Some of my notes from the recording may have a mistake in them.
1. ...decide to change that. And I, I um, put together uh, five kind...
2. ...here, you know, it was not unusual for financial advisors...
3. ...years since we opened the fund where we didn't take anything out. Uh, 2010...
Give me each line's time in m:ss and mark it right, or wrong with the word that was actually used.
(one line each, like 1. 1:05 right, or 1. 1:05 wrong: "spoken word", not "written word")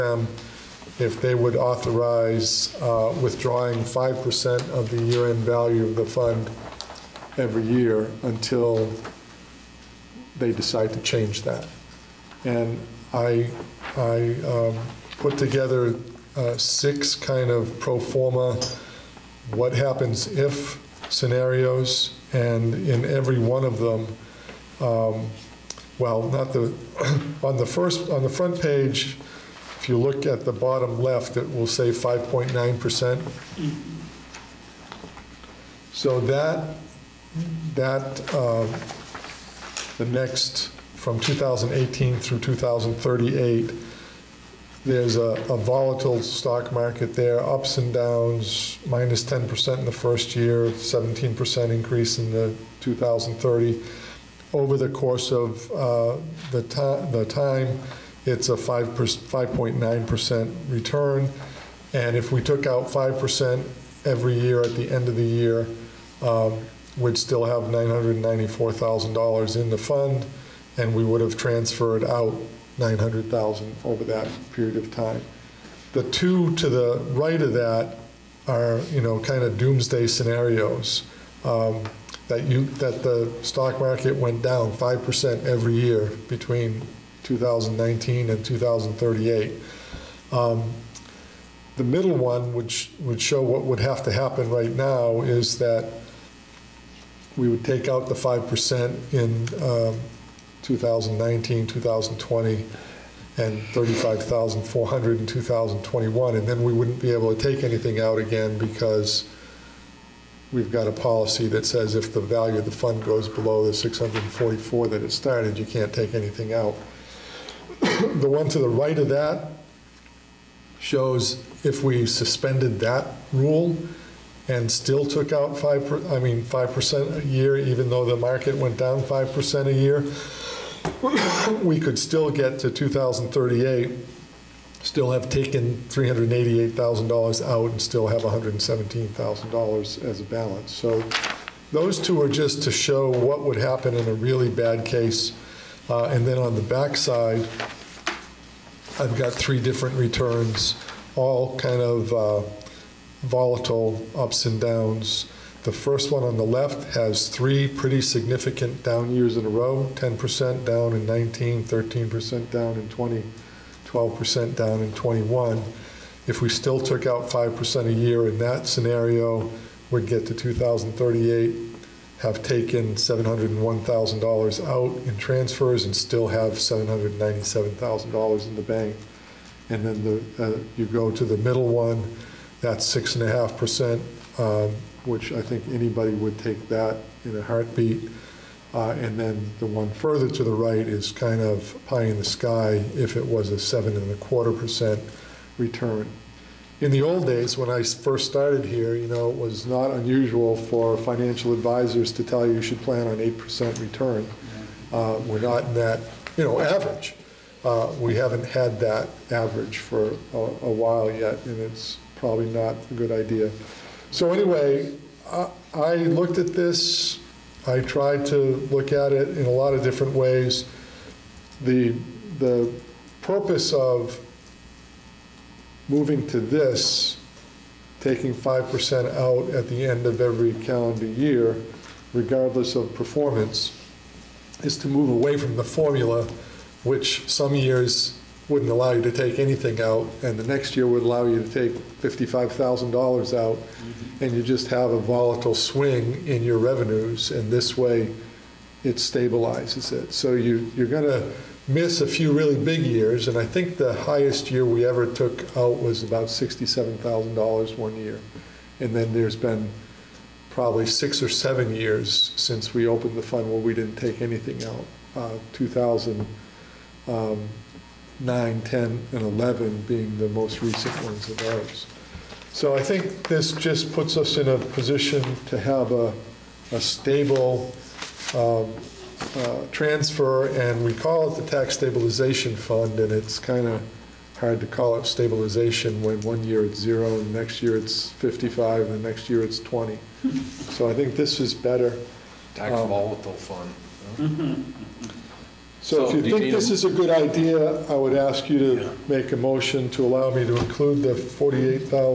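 1. 0:10 wrong: "six", not "five"
2. 3:18 right
3. 4:21 wrong: "2009", not "2010".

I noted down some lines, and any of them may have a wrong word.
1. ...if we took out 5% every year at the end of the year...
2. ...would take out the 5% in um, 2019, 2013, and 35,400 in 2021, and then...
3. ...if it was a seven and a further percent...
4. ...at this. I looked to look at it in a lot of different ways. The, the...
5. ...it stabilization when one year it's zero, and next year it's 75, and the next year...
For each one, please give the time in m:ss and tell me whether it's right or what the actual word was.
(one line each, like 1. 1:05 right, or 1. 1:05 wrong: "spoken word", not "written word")
1. 1:02 right
2. 1:37 wrong: "2020", not "2013"
3. 3:12 wrong: "quarter", not "further"
4. 3:36 wrong: "tried", not "looked"
5. 4:44 wrong: "55", not "75".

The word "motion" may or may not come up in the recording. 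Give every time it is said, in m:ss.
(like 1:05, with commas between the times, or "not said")
4:59.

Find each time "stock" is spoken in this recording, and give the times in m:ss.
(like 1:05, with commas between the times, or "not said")
0:46, 1:23.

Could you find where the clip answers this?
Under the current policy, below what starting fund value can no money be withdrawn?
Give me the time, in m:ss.
1:53.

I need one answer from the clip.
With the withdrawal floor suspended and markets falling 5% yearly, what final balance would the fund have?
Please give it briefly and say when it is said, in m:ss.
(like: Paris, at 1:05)
$117,000, at 2:18.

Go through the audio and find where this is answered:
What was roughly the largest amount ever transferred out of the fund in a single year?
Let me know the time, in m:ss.
4:16.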